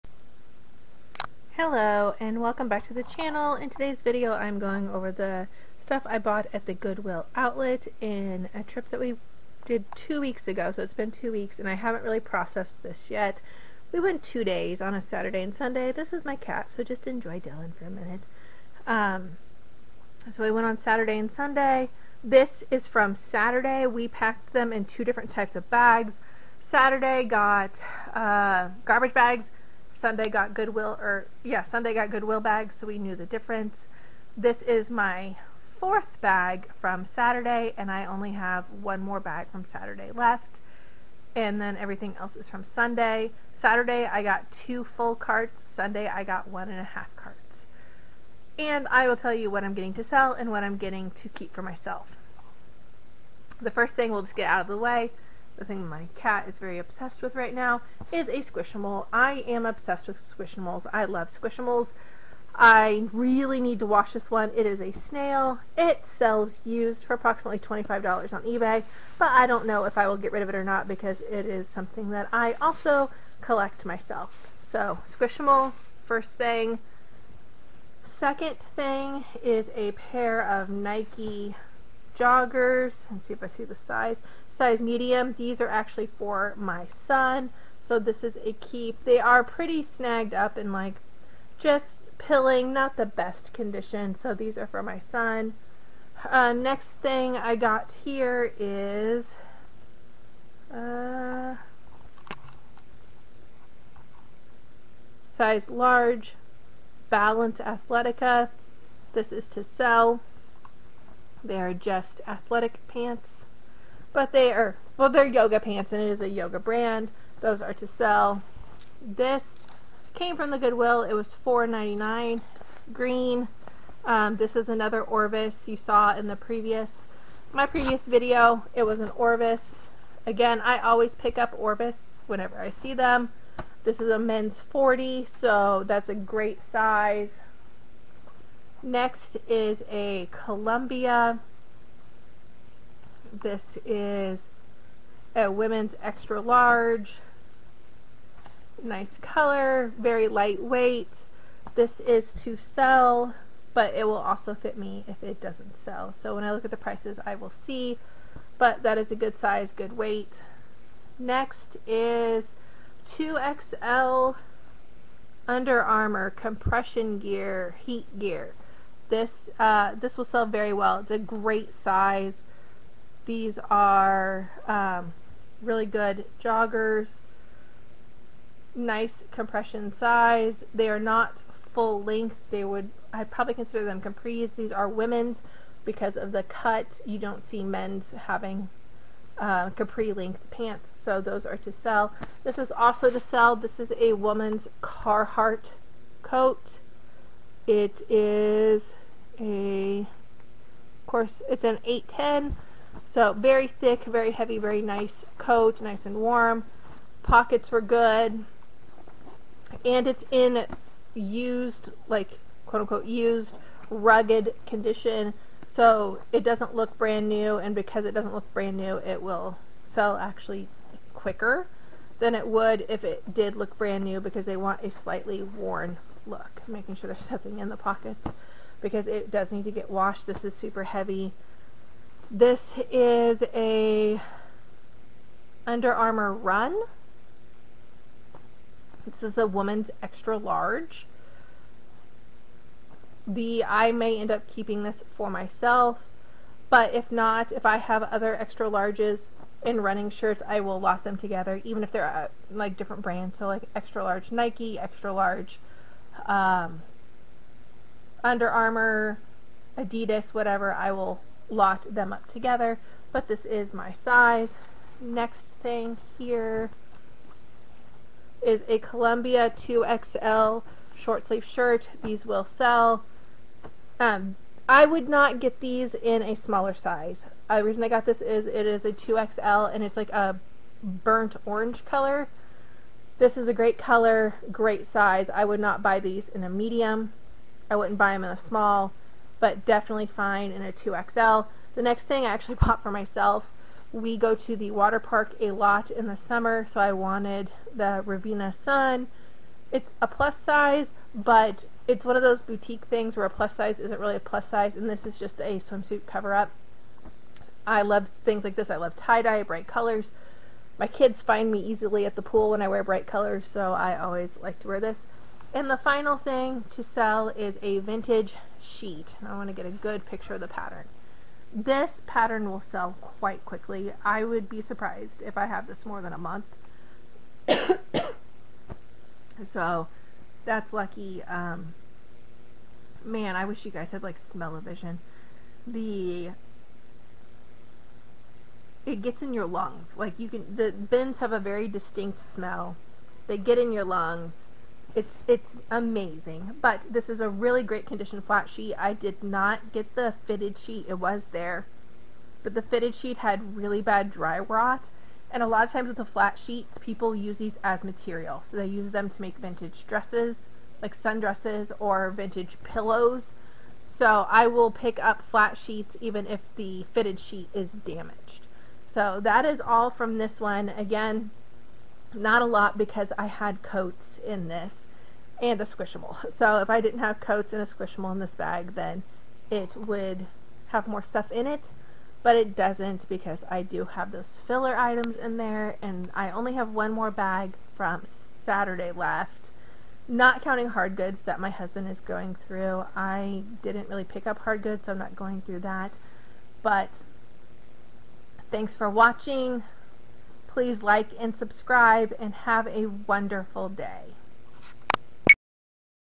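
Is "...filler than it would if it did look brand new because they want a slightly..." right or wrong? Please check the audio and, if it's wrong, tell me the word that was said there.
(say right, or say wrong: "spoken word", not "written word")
wrong: "quicker", not "filler".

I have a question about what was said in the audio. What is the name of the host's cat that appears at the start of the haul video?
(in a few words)
Dylan.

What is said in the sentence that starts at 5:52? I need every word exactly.
But the fitted sheet had really bad dry rot.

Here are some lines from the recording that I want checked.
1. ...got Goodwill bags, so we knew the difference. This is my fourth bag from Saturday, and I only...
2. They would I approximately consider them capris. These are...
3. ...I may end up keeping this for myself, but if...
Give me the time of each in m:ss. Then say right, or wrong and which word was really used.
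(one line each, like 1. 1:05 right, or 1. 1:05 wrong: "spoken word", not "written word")
1. 0:31 right
2. 3:02 wrong: "probably", not "approximately"
3. 4:03 right.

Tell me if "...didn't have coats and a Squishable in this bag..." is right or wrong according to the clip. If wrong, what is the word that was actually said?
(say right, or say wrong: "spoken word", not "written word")
right.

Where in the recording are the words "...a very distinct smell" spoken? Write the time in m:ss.
5:41.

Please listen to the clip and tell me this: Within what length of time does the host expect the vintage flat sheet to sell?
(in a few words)
a month.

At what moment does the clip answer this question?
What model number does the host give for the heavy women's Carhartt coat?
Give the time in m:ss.
3:21.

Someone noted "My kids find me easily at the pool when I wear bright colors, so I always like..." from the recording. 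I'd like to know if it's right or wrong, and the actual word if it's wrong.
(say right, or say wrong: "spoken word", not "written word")
right.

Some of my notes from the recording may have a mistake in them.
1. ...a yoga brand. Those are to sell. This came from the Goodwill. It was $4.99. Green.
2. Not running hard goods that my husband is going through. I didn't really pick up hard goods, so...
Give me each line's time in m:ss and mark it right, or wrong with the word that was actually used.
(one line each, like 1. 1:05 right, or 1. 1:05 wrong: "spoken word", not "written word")
1. 1:56 right
2. 6:30 wrong: "counting", not "running".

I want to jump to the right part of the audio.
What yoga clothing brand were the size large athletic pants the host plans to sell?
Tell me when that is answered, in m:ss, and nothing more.
1:47.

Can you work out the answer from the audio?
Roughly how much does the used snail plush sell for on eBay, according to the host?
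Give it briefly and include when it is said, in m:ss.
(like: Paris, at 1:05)
$25, at 1:07.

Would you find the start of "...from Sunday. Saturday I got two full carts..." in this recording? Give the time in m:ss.
0:42.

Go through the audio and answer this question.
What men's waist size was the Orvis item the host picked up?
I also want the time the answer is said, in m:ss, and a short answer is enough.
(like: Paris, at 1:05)
40, at 2:14.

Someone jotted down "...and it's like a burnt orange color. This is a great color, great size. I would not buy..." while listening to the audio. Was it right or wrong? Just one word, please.
right.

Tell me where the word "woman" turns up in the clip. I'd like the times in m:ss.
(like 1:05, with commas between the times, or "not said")
3:14, 3:59.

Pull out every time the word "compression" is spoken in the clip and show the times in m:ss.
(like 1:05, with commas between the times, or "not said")
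2:46, 2:59.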